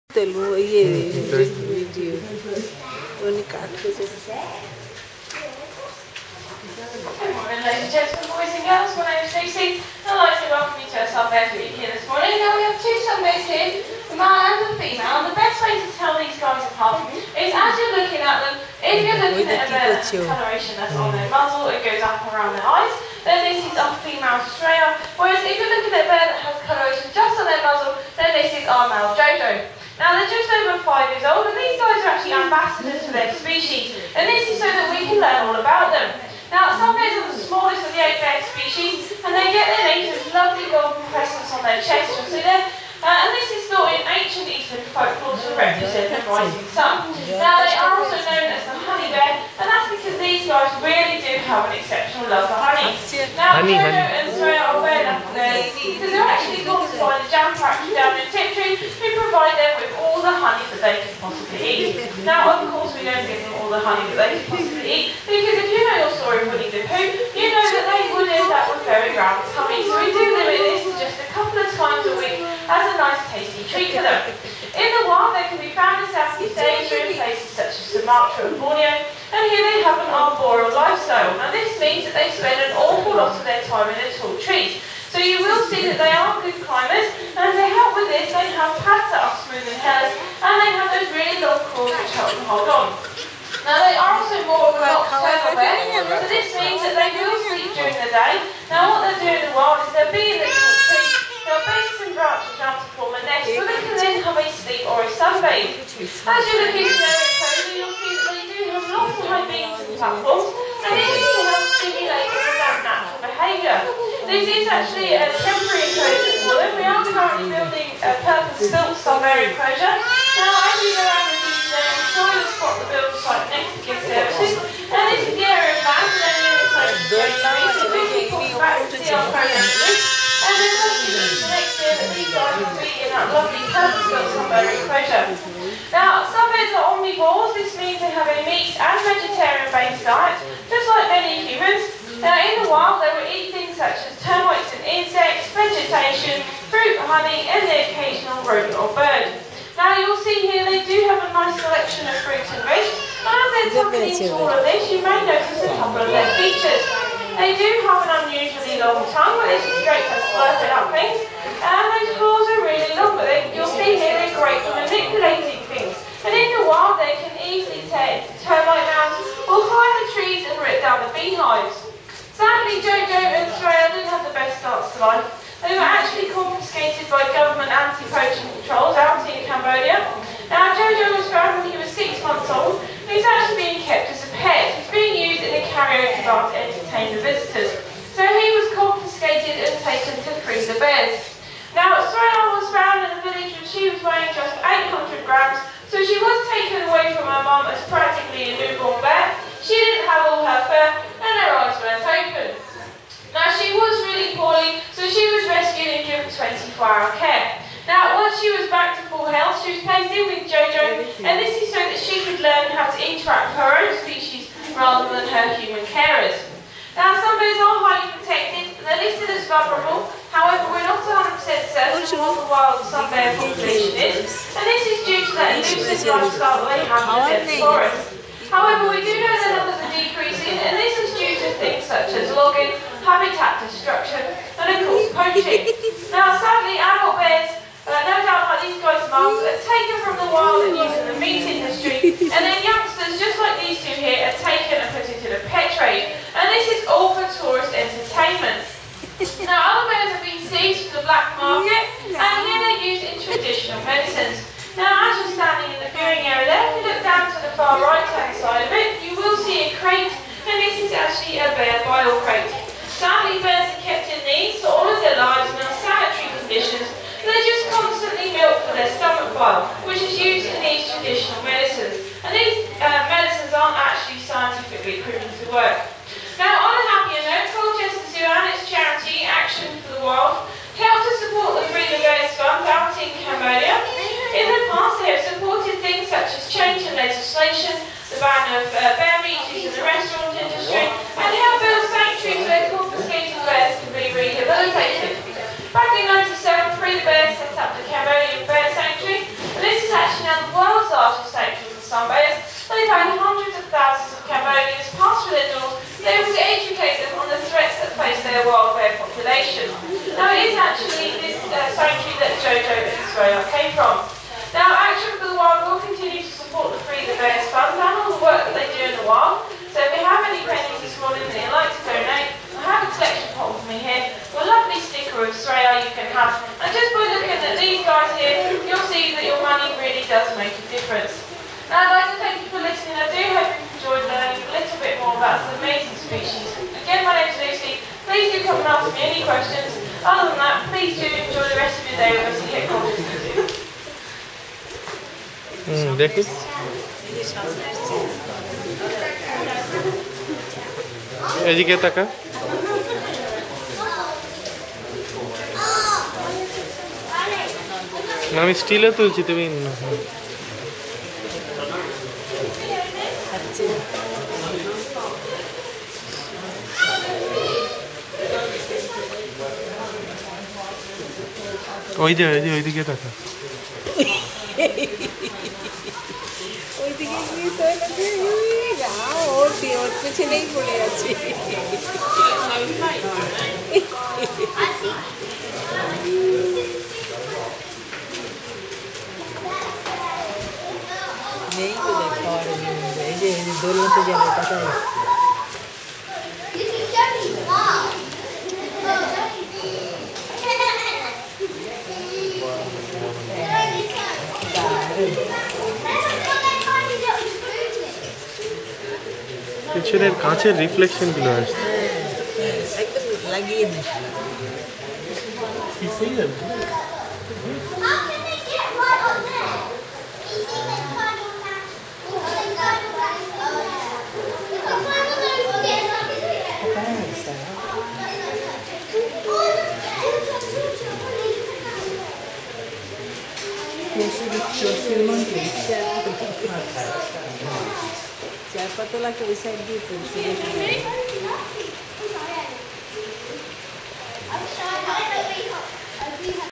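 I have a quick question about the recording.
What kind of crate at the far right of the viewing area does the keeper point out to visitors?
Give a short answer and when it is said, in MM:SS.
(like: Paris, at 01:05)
bear bile crate, at 04:21.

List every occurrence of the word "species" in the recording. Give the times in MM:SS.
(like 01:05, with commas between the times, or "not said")
00:33, 00:38, 03:34, 05:36.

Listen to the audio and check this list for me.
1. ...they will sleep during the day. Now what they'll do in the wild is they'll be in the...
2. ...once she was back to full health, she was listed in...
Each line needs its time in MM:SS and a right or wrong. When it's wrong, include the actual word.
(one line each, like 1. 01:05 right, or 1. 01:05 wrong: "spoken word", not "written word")
1. 01:36 right
2. 03:28 wrong: "placed", not "listed".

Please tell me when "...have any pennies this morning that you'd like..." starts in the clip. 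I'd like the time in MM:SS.
05:20.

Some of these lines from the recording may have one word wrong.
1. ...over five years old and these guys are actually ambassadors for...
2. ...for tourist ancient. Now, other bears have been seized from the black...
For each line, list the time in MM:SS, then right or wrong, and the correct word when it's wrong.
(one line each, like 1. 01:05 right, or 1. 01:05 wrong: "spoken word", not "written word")
1. 00:30 right
2. 04:07 wrong: "entertainment", not "ancient".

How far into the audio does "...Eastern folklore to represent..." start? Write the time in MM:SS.
00:44.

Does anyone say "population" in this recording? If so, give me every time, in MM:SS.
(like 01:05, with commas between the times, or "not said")
03:43, 05:08.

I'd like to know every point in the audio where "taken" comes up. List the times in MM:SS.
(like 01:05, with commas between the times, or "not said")
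03:59, 04:04.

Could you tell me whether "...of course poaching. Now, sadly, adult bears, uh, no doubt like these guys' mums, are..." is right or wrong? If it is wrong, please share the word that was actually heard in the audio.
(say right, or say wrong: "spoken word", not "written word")
right.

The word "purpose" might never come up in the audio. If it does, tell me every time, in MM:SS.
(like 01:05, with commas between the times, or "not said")
01:58.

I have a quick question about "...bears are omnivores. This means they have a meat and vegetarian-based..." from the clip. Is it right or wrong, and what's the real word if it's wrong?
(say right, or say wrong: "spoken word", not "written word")
right.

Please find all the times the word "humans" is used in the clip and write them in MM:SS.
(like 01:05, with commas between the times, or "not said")
02:21, 03:35.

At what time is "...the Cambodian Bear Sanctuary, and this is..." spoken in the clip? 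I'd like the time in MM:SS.
04:57.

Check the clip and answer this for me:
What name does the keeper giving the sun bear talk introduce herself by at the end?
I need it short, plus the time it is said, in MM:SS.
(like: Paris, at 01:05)
Lucy, at 05:37.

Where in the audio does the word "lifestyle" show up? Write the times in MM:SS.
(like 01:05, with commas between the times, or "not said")
01:20, 03:46.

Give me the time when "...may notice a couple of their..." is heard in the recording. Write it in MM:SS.
02:35.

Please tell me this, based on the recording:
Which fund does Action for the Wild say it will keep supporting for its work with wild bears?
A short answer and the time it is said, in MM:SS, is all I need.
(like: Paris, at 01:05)
Free the Bears Fund, at 05:16.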